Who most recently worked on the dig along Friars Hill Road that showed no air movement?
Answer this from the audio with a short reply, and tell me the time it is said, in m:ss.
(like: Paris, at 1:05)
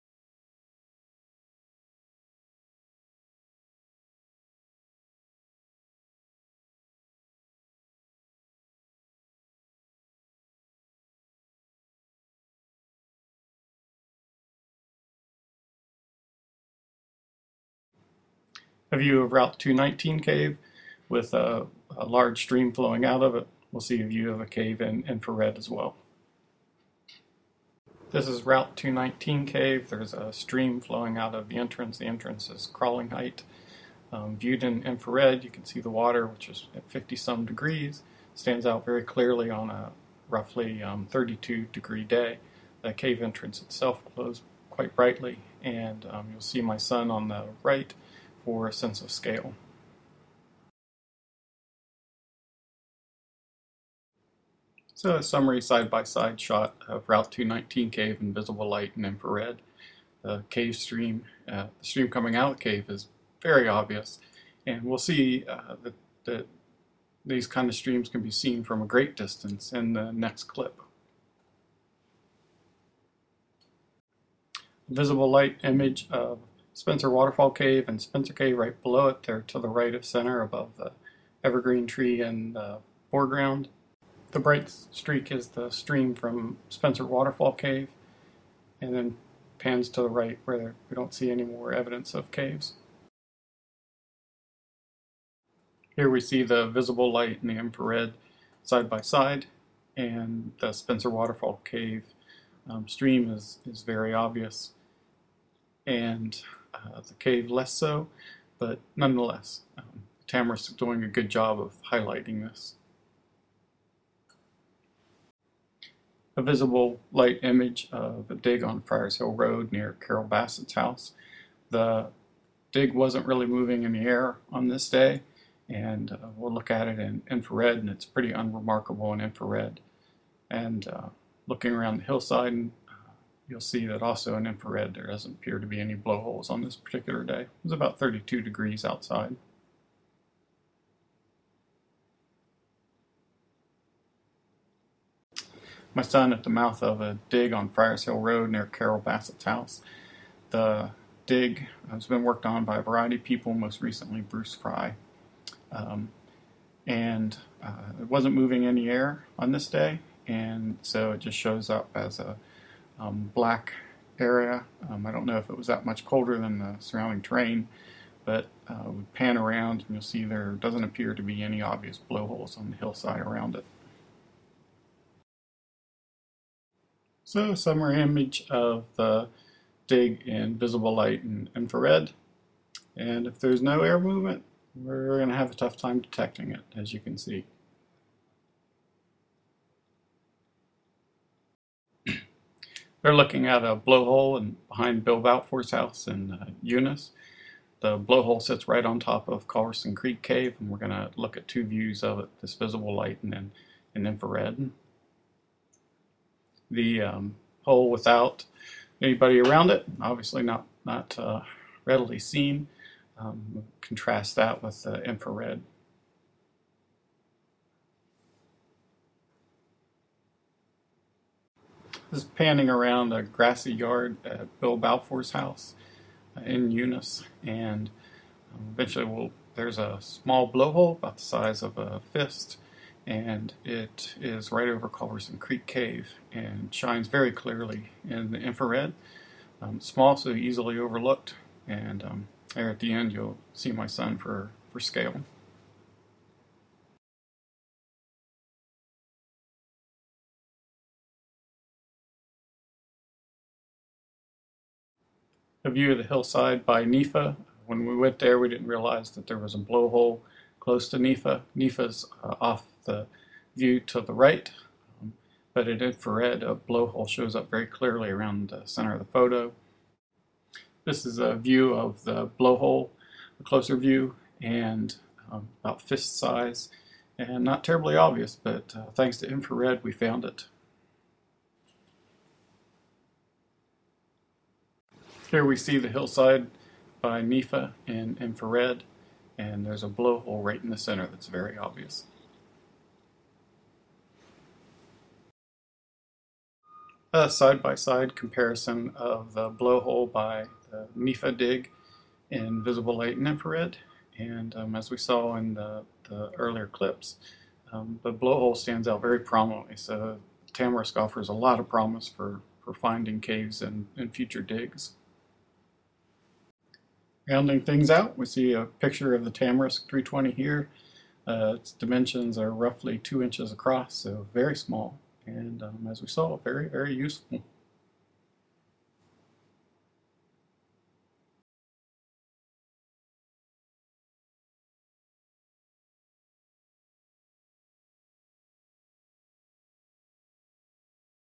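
Bruce Fry, at 2:34.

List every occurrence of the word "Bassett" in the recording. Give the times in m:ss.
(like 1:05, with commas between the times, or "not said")
2:00, 2:28.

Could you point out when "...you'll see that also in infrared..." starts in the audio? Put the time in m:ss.
2:13.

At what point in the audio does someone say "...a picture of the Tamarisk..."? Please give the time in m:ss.
5:18.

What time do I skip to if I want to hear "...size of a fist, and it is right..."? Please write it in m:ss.
3:51.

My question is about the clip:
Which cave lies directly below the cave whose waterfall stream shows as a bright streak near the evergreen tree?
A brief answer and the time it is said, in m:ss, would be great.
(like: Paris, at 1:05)
Spencer Cave, at 1:18.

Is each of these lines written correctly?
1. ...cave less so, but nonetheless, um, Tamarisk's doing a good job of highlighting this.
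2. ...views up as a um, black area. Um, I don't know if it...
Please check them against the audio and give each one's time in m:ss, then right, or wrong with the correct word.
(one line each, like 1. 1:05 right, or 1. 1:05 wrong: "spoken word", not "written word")
1. 1:47 right
2. 2:41 wrong: "shows", not "views".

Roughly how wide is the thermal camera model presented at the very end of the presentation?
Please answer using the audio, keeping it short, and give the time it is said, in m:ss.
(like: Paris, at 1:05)
2 inches, at 5:22.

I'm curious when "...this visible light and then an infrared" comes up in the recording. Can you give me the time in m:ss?
3:22.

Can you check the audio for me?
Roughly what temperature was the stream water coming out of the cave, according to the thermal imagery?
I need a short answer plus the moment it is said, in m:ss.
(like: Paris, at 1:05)
50 some degrees, at 0:36.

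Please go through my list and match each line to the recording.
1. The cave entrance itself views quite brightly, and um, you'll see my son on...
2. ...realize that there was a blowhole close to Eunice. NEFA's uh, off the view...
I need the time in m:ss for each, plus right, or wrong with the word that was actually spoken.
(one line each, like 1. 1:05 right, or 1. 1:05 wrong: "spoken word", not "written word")
1. 0:42 wrong: "glows", not "views"
2. 4:18 wrong: "NEFA", not "Eunice".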